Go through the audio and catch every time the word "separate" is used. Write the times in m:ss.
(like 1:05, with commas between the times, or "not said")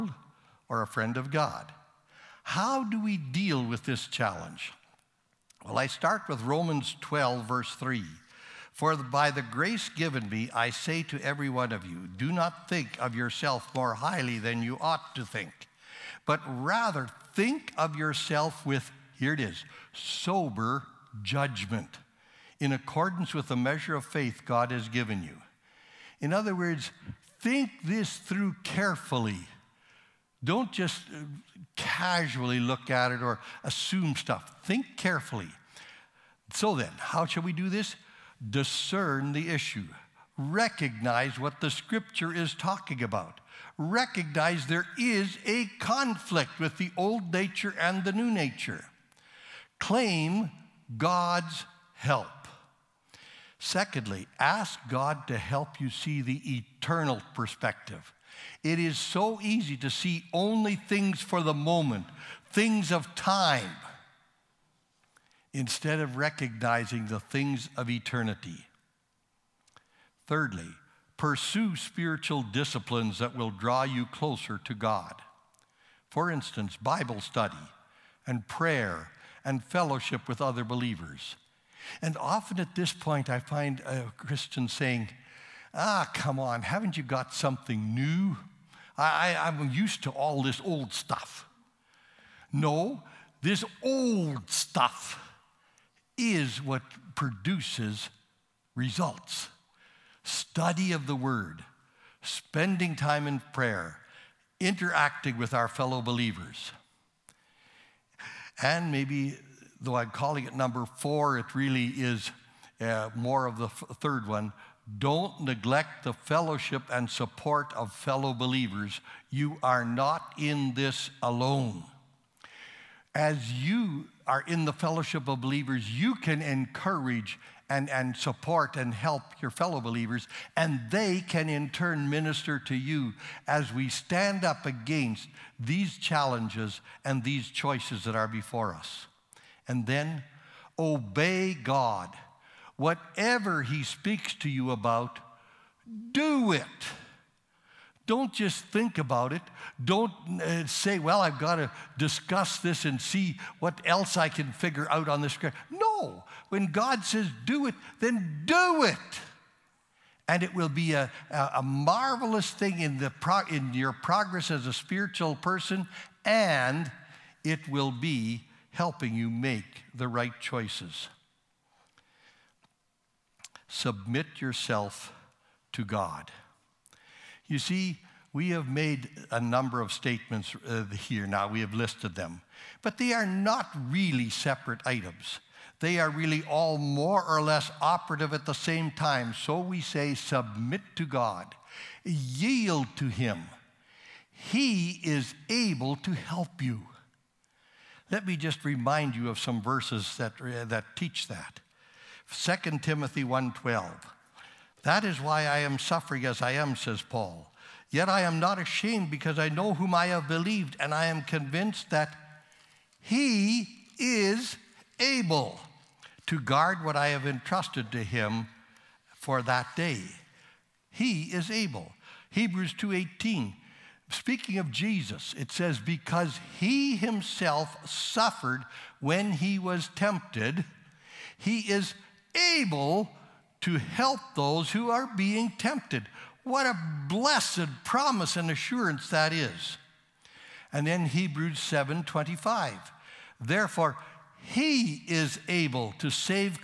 3:04.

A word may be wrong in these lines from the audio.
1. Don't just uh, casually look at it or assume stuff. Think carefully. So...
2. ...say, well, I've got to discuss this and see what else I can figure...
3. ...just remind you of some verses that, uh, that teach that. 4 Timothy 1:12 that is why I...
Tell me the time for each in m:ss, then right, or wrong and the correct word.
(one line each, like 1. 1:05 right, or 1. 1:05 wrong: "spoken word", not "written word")
1. 0:30 right
2. 2:30 right
3. 3:18 wrong: "2", not "4".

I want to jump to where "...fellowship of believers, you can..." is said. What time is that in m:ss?
2:04.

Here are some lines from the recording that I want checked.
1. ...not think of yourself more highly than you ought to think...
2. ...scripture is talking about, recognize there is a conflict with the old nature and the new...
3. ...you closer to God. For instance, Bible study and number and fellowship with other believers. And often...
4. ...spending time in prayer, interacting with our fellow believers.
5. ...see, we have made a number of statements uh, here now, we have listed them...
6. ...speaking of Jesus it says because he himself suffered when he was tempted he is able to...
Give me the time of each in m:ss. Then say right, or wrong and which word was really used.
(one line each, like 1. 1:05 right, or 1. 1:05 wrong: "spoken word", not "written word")
1. 0:12 right
2. 0:41 right
3. 1:13 wrong: "prayer", not "number"
4. 1:42 right
5. 2:57 right
6. 3:44 right.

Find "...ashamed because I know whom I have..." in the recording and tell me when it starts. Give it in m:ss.
3:28.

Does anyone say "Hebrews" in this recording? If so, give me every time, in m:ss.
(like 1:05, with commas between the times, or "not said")
3:42, 4:01.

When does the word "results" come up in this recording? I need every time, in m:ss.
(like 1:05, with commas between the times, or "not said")
1:38.